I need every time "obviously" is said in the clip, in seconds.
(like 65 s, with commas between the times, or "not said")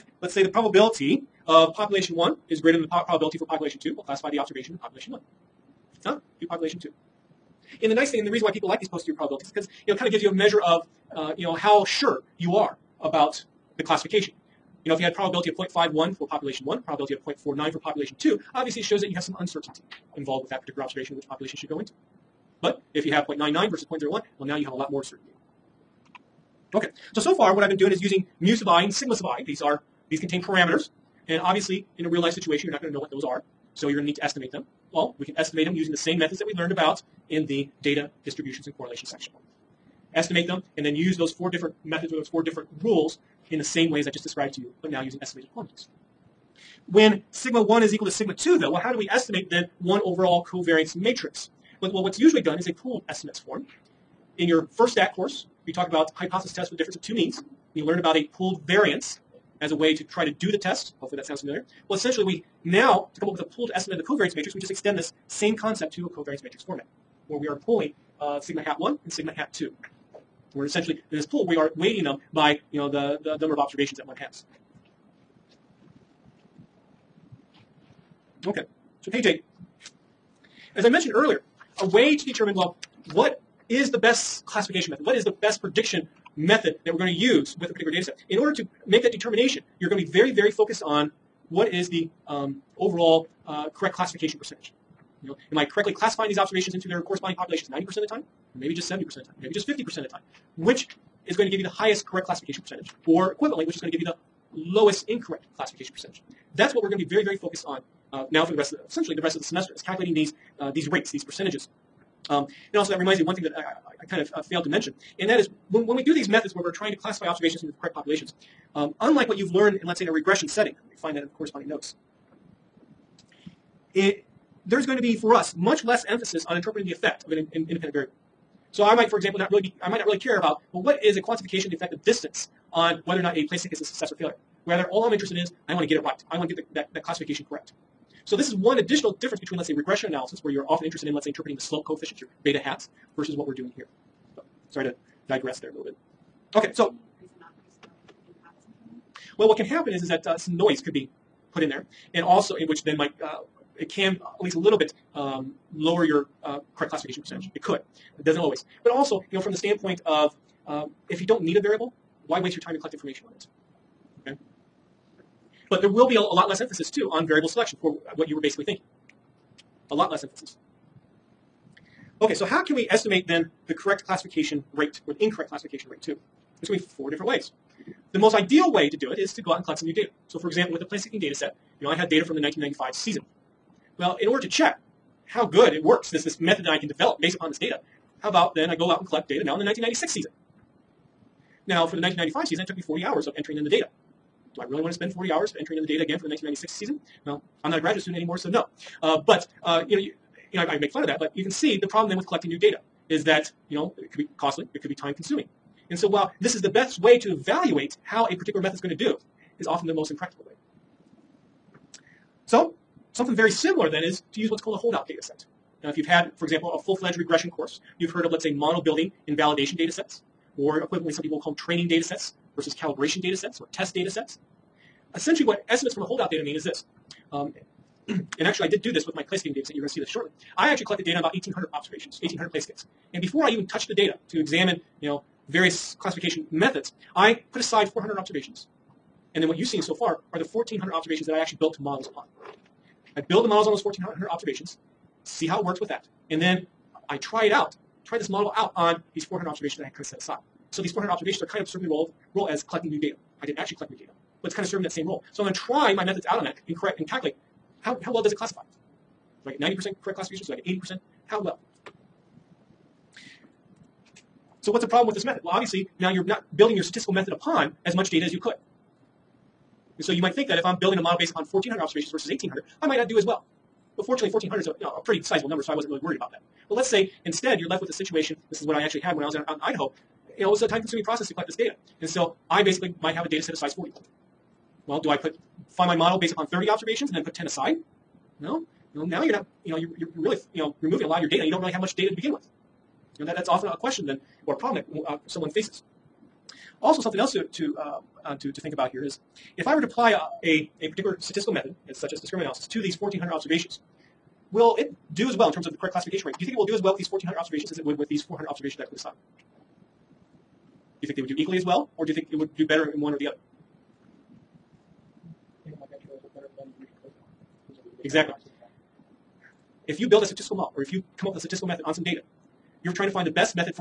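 18 s, 31 s, 265 s.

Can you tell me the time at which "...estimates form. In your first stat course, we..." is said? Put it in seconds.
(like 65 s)
53 s.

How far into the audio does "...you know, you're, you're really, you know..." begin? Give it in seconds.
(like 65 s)
289 s.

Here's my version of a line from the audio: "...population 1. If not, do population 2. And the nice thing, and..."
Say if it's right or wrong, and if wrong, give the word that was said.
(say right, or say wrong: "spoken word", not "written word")
right.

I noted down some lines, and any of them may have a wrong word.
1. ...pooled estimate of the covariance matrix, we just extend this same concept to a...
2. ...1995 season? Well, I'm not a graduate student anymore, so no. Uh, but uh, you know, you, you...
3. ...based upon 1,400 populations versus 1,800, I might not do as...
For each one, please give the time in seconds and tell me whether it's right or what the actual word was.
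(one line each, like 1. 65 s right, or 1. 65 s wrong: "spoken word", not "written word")
1. 63 s right
2. 196 s wrong: "1996", not "1995"
3. 271 s wrong: "observations", not "populations".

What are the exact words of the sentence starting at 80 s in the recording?
As I mentioned earlier, a way to determine, well, what is the best classification method?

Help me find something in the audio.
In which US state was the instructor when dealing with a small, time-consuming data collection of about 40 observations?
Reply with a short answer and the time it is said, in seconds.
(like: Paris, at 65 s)
Idaho, at 279 s.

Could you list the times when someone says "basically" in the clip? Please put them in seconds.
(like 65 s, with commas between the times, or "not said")
168 s, 282 s.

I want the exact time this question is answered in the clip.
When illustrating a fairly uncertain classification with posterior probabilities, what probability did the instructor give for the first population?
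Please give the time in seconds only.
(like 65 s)
15 s.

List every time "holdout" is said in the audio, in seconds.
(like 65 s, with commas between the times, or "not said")
214 s, 226 s.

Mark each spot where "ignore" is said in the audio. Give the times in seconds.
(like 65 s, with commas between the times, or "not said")
not said.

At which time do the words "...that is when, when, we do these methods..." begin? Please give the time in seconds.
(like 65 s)
115 s.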